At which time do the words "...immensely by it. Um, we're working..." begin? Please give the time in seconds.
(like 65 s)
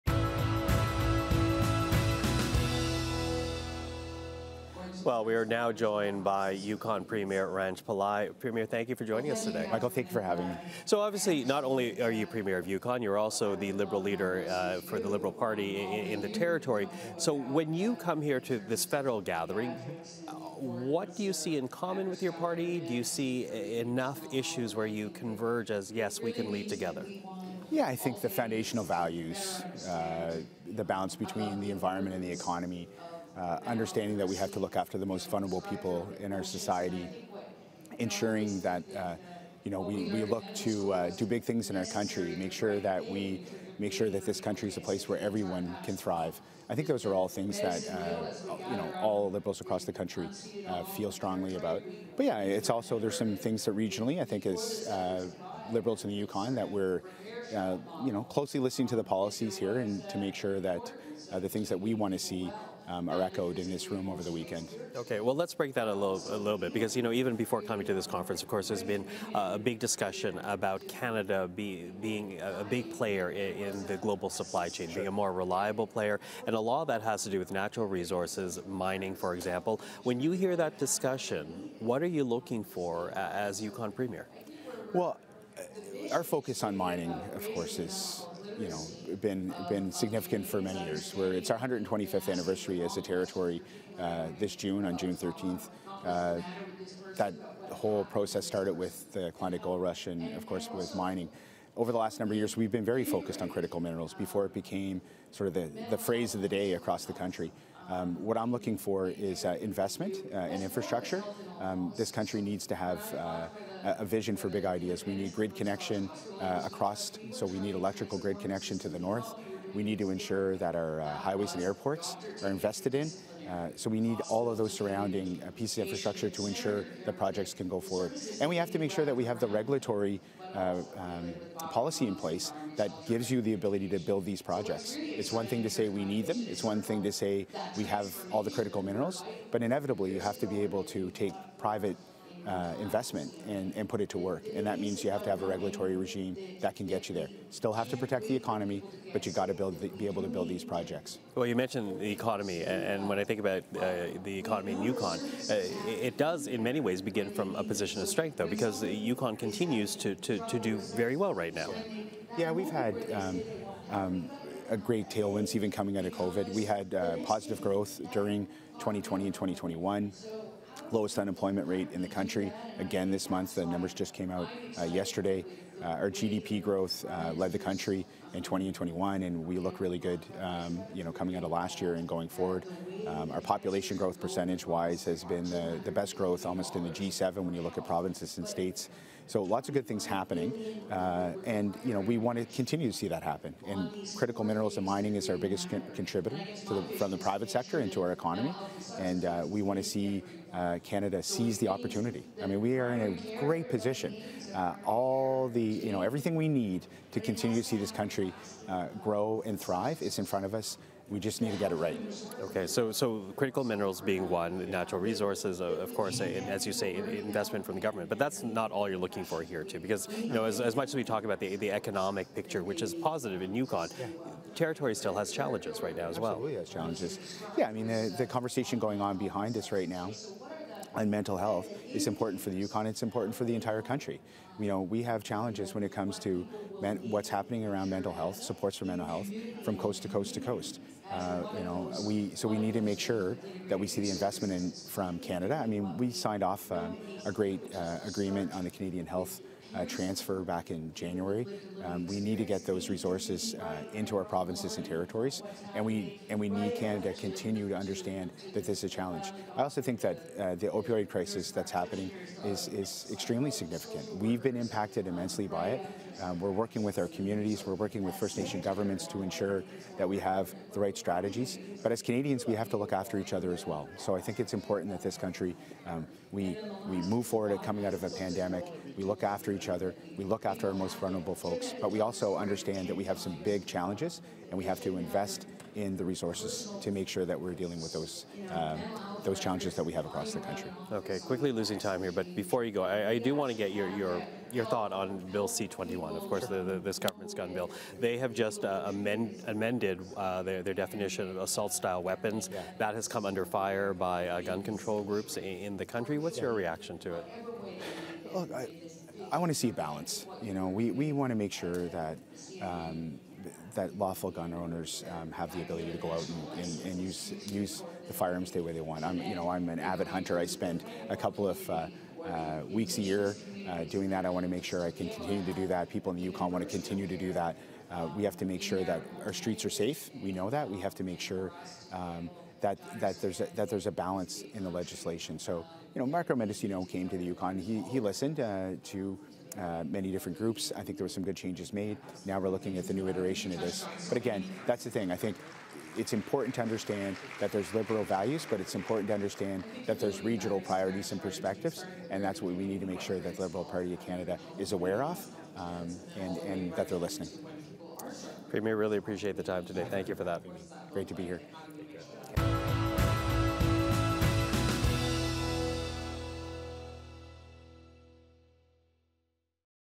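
265 s.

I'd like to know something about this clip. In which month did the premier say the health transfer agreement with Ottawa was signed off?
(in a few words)
January.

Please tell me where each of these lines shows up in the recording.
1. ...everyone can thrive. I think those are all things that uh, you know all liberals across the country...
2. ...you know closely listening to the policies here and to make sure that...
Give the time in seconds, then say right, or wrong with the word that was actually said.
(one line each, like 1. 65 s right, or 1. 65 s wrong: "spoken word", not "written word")
1. 45 s right
2. 58 s right.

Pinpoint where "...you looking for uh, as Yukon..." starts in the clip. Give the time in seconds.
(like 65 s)
82 s.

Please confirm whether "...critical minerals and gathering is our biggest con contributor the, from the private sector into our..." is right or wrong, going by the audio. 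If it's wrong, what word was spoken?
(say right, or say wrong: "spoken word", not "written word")
wrong: "mining", not "gathering".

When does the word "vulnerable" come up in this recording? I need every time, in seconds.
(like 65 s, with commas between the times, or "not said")
35 s, 280 s.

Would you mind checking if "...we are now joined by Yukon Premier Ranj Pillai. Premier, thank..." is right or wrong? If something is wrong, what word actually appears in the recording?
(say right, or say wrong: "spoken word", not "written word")
right.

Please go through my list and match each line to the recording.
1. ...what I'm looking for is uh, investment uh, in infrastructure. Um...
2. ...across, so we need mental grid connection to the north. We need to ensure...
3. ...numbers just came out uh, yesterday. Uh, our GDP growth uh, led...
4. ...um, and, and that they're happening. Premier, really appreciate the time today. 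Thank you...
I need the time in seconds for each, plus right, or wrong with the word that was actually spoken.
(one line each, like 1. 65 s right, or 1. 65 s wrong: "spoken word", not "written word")
1. 108 s right
2. 116 s wrong: "electrical", not "mental"
3. 173 s right
4. 355 s wrong: "listening", not "happening".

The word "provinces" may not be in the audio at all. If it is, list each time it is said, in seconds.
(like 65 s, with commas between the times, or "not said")
187 s, 254 s.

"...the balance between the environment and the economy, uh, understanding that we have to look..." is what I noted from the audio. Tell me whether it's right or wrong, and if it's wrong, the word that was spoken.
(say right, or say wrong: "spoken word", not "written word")
right.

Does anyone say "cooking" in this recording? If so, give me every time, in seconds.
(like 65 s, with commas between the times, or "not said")
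not said.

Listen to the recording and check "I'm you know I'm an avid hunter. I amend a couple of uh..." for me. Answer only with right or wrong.
wrong.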